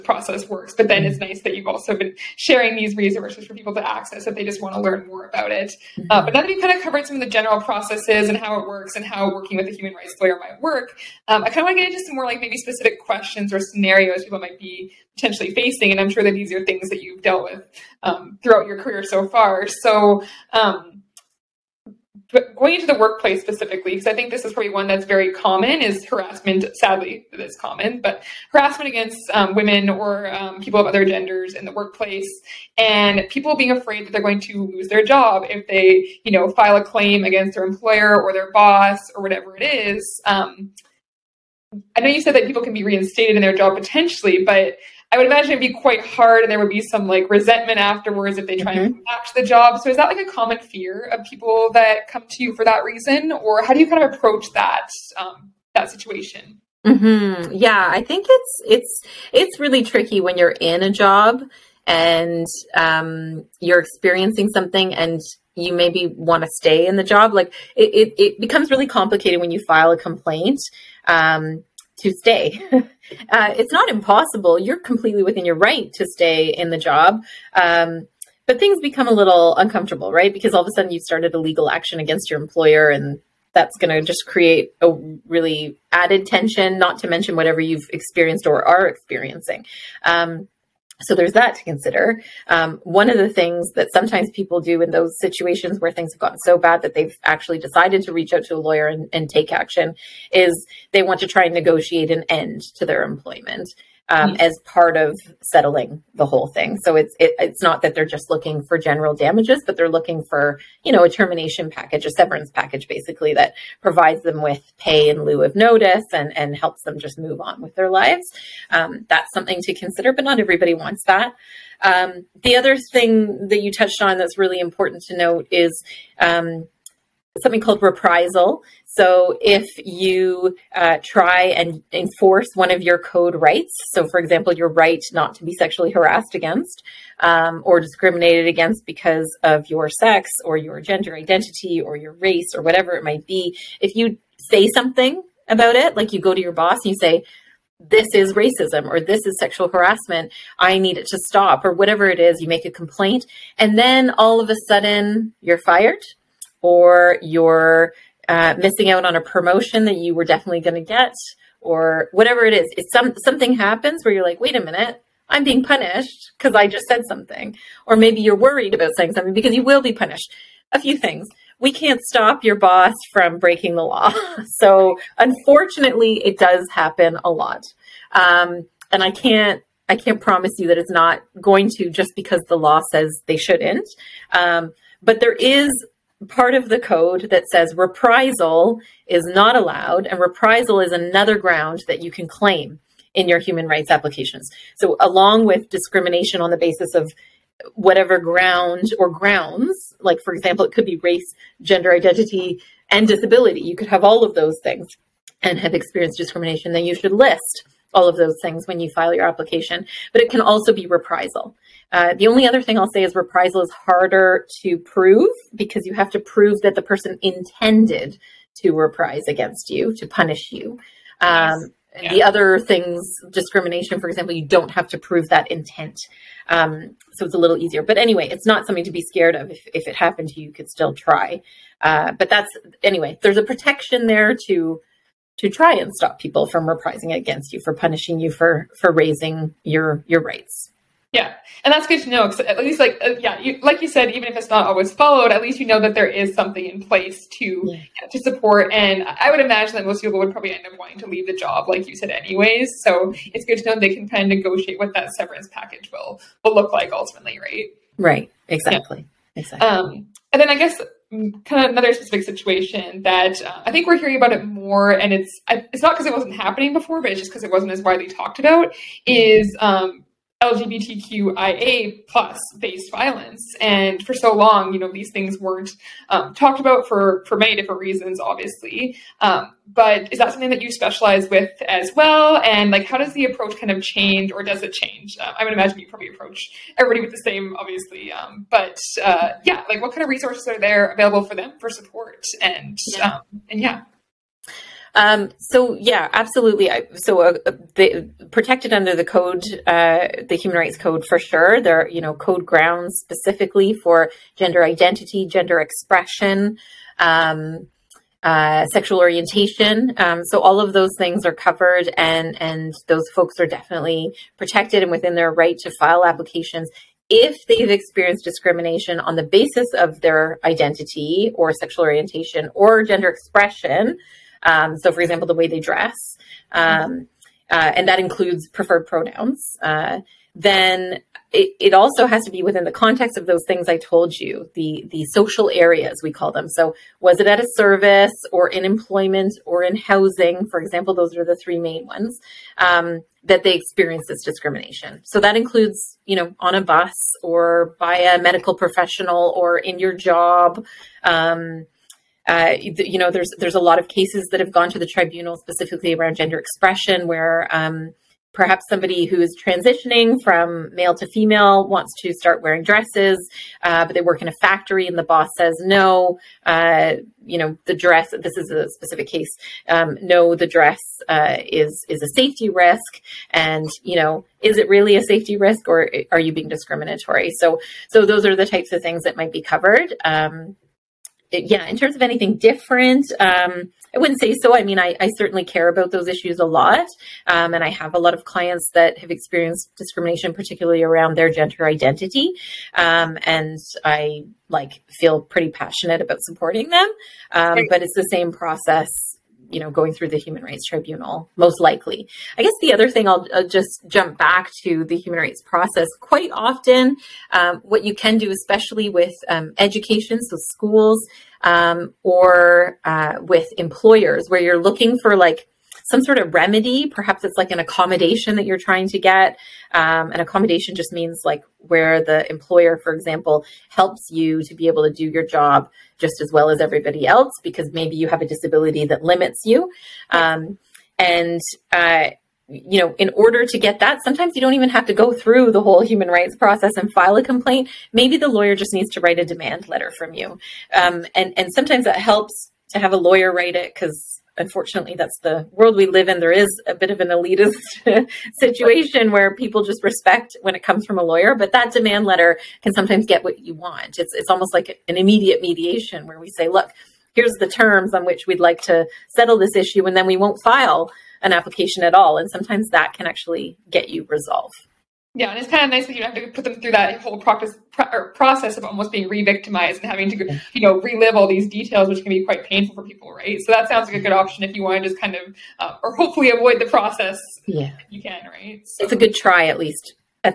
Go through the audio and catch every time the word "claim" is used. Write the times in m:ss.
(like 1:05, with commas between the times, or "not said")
0:36, 3:12.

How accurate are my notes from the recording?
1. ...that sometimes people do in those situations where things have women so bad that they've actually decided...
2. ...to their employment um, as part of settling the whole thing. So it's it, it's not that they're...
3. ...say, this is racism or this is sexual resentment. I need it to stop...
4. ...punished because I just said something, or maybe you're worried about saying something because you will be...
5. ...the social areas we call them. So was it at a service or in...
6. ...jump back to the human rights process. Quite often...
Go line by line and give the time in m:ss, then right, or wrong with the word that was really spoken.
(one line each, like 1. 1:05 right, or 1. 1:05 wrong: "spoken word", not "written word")
1. 1:33 wrong: "gotten", not "women"
2. 1:42 right
3. 2:26 wrong: "harassment", not "resentment"
4. 2:45 right
5. 5:34 right
6. 6:43 right.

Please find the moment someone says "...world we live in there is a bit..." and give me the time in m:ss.
7:25.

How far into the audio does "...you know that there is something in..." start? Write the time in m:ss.
4:05.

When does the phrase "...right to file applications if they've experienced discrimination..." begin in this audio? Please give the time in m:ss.
5:15.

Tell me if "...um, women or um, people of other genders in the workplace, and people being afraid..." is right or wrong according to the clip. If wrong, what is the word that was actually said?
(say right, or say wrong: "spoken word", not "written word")
right.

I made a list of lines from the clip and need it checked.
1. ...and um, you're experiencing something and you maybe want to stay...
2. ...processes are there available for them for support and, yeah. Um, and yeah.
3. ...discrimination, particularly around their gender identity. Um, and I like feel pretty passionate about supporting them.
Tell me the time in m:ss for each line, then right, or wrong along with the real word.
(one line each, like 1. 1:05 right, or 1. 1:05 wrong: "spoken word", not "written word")
1. 1:01 right
2. 4:50 wrong: "resources", not "processes"
3. 6:29 right.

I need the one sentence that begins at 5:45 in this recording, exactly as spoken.
So that includes, you know, on a bus or by a medical professional or in your job.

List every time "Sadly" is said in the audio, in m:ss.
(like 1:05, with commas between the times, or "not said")
0:26.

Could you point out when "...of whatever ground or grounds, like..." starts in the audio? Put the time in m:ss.
3:16.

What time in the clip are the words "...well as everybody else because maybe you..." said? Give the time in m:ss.
7:06.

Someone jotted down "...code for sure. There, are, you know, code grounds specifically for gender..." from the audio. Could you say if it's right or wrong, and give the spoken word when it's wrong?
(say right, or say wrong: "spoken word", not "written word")
right.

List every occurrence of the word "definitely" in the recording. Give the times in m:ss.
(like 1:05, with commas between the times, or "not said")
2:40, 5:13.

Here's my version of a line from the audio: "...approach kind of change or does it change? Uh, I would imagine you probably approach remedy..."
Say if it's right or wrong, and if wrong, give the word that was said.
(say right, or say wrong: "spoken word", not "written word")
wrong: "everybody", not "remedy".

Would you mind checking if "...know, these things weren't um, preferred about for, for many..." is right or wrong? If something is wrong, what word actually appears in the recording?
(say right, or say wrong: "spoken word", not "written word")
wrong: "talked", not "preferred".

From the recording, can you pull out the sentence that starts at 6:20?
Um, yeah, in terms of anything different, um, I wouldn't say so.